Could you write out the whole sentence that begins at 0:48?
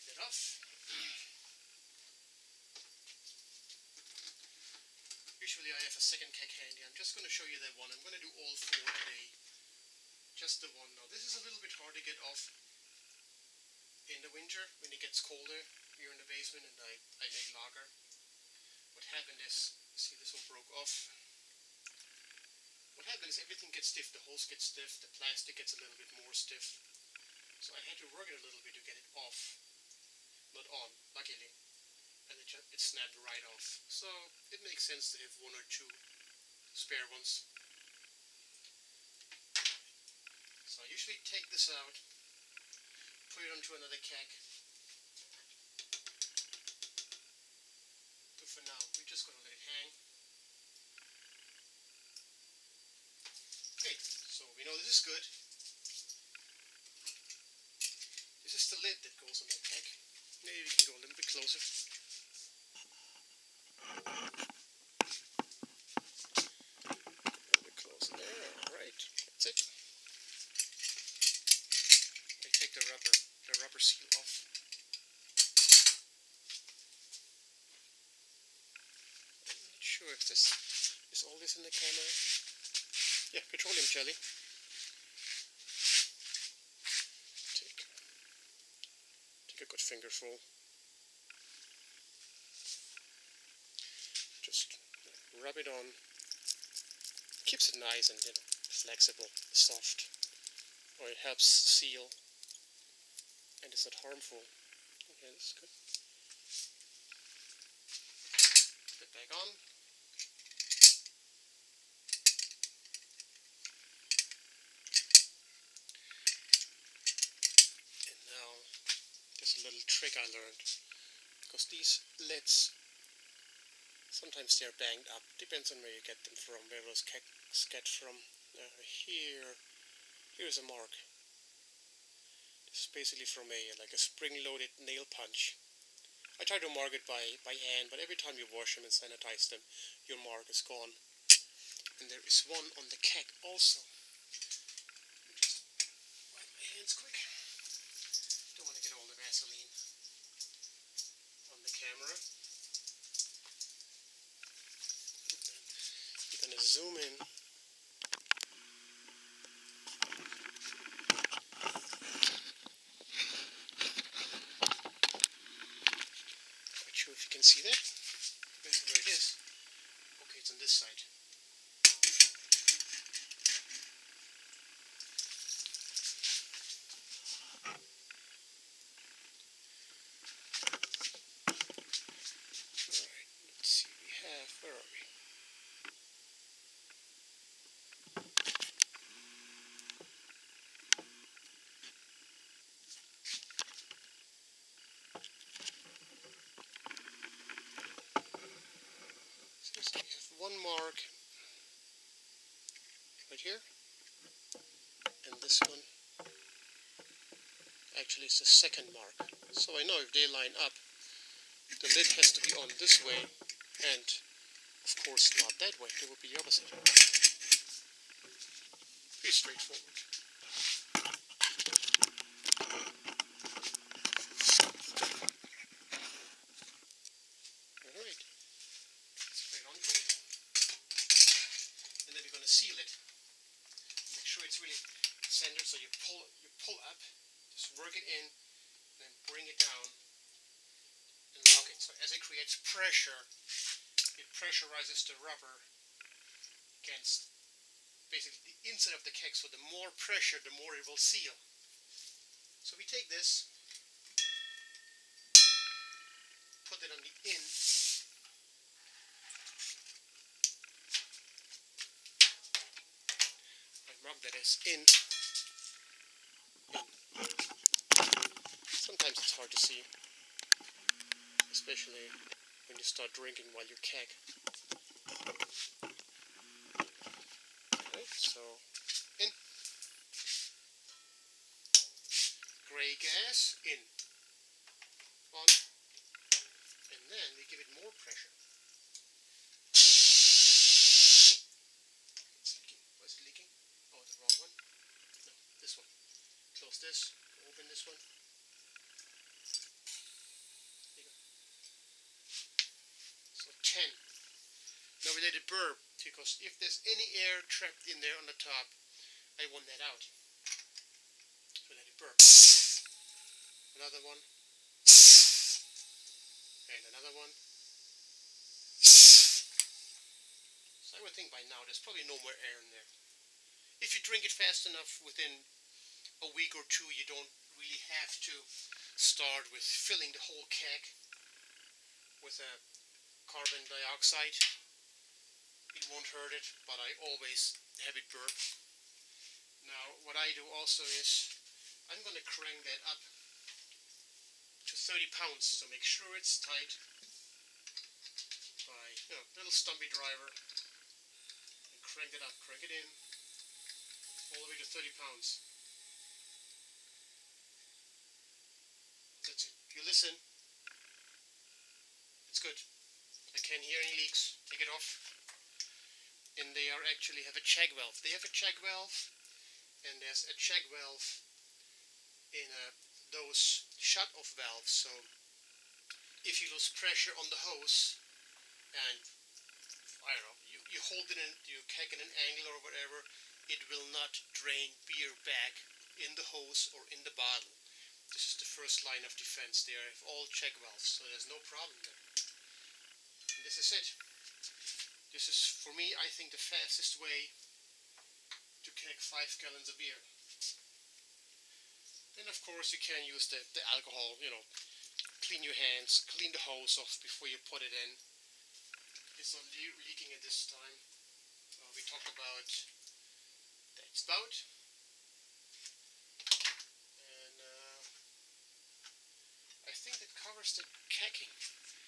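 But for now, we're just going to let it hang.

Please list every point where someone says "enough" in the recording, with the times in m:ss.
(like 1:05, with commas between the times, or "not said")
5:24.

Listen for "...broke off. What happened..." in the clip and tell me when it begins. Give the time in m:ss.
0:20.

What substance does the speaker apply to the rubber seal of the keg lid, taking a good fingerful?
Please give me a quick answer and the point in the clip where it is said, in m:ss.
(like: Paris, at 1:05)
Petroleum jelly, at 1:23.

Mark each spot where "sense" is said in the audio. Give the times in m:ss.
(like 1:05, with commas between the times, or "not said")
0:34.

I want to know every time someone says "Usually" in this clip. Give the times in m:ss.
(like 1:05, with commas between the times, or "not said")
0:05.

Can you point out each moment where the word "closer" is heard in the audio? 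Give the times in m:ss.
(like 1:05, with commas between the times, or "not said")
1:01, 1:07.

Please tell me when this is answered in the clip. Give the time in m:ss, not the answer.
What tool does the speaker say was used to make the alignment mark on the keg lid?
2:13.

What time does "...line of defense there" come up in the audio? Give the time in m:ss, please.
6:28.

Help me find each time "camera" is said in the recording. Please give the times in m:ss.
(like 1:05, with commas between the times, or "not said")
1:21, 2:31.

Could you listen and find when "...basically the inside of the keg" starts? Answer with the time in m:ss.
4:08.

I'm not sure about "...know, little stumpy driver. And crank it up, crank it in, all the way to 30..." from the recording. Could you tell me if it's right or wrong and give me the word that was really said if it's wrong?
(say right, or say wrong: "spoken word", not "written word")
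right.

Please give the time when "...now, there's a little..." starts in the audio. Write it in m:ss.
1:58.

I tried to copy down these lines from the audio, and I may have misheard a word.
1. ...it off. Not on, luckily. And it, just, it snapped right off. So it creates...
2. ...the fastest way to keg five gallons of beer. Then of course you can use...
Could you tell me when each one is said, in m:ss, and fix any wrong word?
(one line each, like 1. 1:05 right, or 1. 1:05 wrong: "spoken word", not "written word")
1. 0:28 wrong: "makes", not "creates"
2. 6:36 right.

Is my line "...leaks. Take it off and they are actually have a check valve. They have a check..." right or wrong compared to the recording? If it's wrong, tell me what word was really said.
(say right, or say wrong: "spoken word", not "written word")
right.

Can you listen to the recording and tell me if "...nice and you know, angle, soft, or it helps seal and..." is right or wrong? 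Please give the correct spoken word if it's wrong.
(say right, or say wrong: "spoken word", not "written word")
wrong: "flexible", not "angle".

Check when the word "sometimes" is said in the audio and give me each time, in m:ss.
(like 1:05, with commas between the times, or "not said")
2:04, 4:28.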